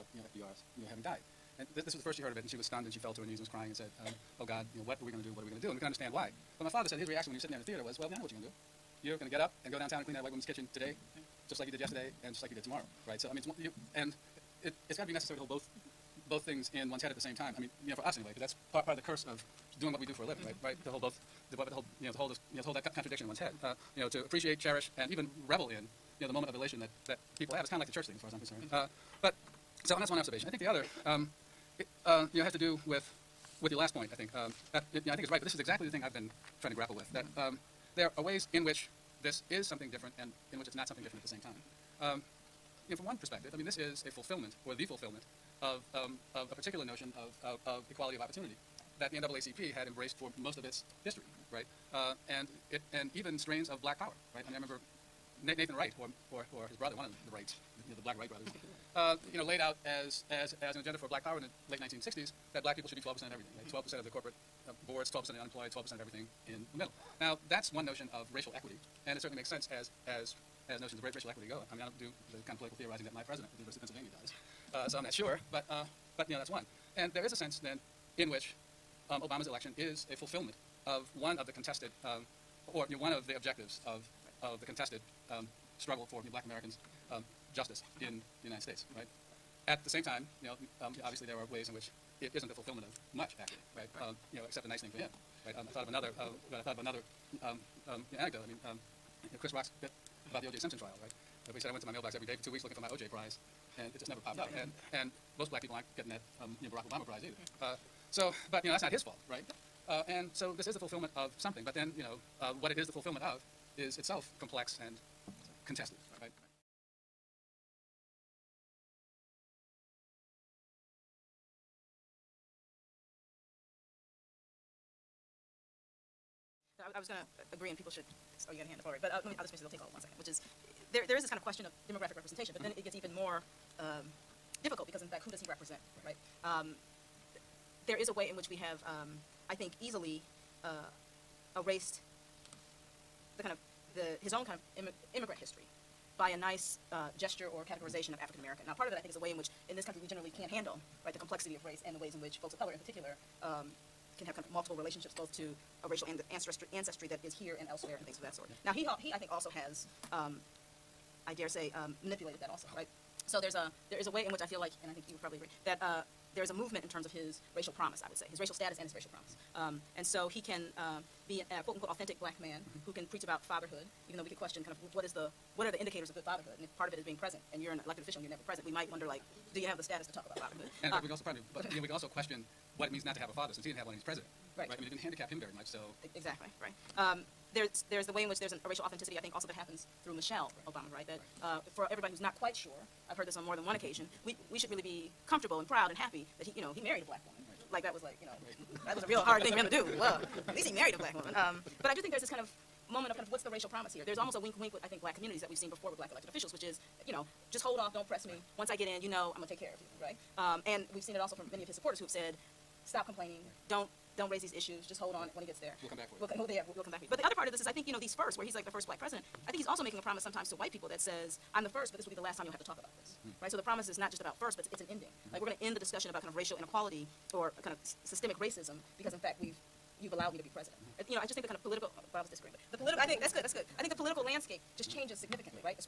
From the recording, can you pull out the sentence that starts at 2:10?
Which is, there there is this kind of question of demographic representation, but mm -hmm.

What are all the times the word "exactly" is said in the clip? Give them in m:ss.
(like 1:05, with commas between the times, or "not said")
0:35, 3:06.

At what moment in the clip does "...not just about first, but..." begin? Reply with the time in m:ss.
3:43.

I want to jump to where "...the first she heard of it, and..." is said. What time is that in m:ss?
0:01.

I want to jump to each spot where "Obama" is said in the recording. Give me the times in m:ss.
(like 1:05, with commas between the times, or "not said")
1:19, 1:46, 3:10.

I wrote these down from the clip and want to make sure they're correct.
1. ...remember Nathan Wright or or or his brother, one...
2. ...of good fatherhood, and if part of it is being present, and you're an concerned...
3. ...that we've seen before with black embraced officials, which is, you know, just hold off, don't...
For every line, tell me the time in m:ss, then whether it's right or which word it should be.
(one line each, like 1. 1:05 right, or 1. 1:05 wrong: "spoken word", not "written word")
1. 0:54 right
2. 2:56 wrong: "elected", not "concerned"
3. 3:25 wrong: "elected", not "embraced".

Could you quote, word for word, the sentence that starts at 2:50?
Uh, be a quote unquote authentic black man mm -hmm.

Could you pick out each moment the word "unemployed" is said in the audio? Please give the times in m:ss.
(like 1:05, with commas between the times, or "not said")
1:05.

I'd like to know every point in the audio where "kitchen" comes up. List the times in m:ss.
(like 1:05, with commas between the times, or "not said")
0:10.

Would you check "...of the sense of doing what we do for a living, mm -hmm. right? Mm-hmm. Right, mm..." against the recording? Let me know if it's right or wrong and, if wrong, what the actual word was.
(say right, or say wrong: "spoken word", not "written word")
wrong: "curse", not "sense".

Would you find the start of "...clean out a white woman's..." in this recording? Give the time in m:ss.
0:10.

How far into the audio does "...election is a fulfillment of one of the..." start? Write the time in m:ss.
1:19.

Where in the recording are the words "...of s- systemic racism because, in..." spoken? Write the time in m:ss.
3:47.